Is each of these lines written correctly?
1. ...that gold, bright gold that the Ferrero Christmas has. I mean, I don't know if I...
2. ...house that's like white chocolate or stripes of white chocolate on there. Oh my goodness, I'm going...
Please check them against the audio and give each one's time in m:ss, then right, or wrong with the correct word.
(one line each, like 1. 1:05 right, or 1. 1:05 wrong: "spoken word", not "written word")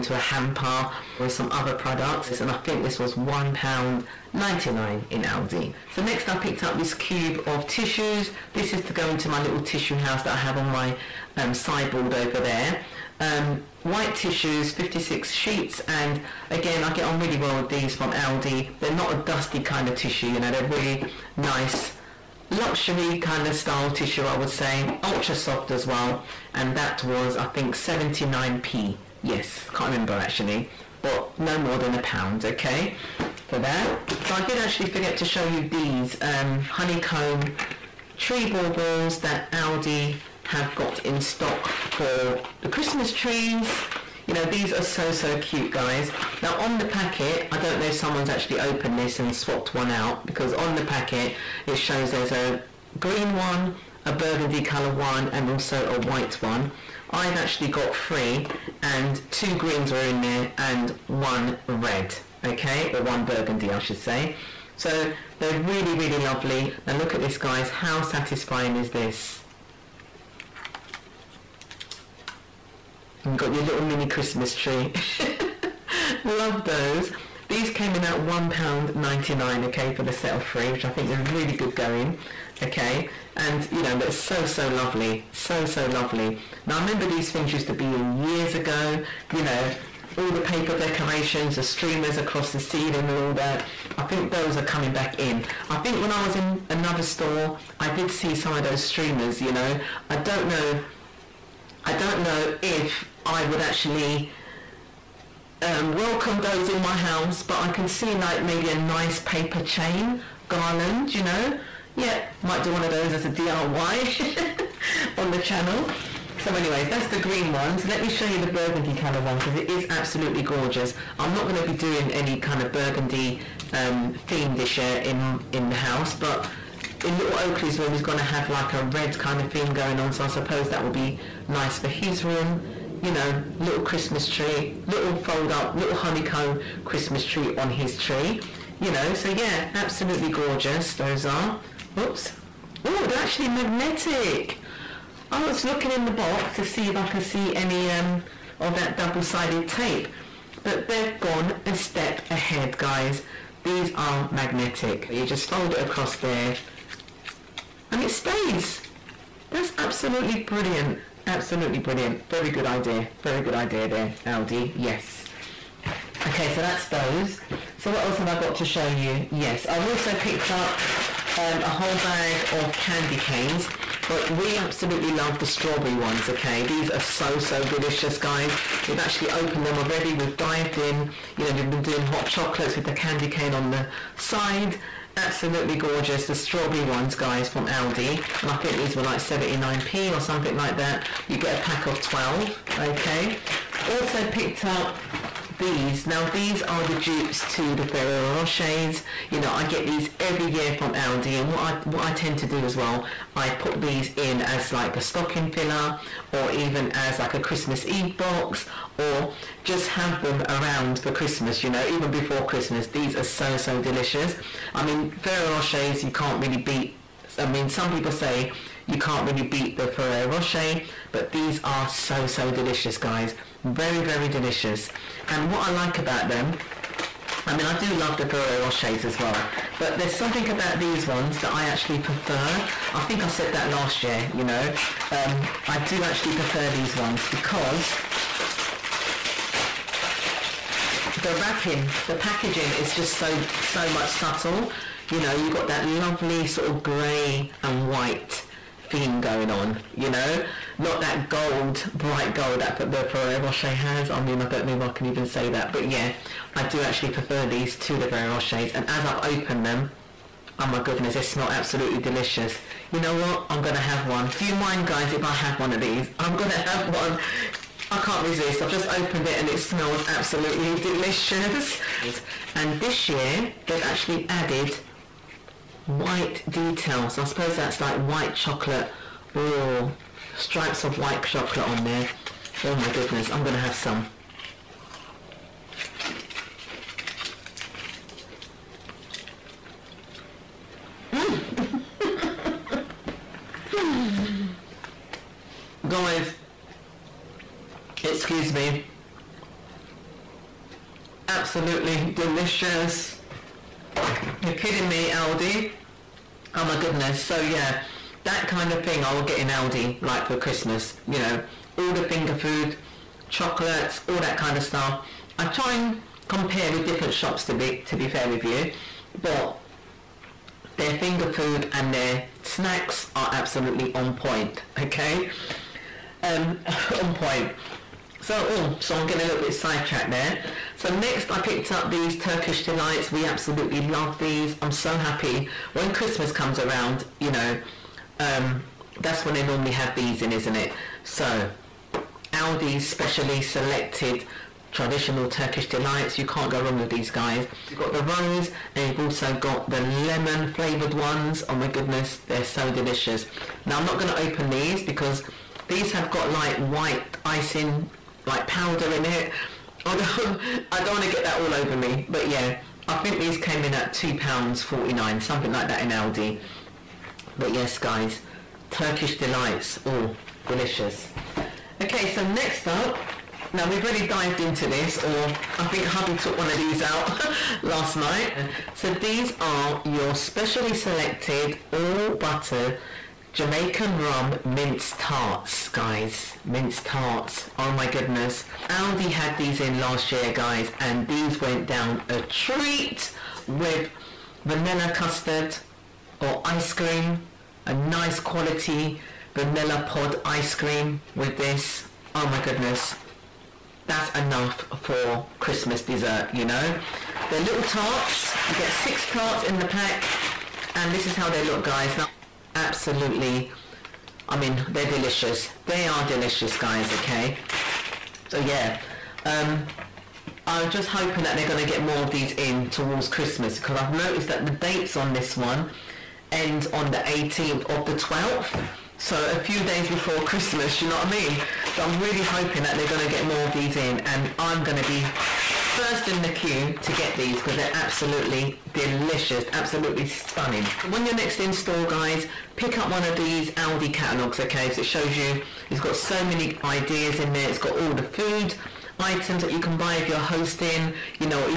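1. 4:11 wrong: "Rocher", not "Christmas"
2. 4:37 wrong: "suppose", not "house".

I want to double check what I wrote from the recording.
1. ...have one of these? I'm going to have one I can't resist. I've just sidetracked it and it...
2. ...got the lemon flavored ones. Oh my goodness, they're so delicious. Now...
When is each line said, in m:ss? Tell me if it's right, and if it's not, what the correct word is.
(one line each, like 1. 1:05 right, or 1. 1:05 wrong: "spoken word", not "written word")
1. 4:25 wrong: "opened", not "sidetracked"
2. 5:49 right.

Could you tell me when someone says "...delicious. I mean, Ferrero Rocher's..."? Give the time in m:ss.
3:33.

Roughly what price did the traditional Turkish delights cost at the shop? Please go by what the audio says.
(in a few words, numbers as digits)
£2.49.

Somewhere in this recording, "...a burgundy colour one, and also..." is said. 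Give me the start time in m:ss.
0:54.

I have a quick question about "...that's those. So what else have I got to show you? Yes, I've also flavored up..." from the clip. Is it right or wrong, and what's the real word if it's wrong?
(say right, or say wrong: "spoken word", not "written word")
wrong: "picked", not "flavored".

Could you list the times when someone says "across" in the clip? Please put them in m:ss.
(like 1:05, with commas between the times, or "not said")
1:32, 2:35.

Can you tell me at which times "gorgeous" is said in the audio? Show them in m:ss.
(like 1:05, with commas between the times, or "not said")
2:00, 2:20, 3:05.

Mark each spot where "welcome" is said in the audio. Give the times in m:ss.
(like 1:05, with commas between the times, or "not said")
1:45.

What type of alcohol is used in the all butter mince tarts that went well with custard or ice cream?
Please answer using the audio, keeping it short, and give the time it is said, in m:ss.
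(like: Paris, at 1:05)
Jamaican rum, at 6:23.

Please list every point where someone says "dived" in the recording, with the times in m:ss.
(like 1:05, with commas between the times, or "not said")
3:00, 6:14.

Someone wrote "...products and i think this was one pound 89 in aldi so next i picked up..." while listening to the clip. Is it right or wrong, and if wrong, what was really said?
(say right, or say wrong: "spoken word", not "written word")
wrong: "99", not "89".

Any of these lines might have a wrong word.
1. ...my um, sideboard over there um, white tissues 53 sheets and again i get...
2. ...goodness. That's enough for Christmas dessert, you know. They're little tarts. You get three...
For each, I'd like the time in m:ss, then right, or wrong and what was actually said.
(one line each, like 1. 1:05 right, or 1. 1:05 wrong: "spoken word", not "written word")
1. 0:10 wrong: "56", not "53"
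2. 6:42 wrong: "six", not "three".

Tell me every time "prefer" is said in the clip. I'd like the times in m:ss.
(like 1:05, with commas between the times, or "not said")
3:51, 3:56, 4:17.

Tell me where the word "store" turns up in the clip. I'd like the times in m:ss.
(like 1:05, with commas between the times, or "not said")
1:37, 7:21.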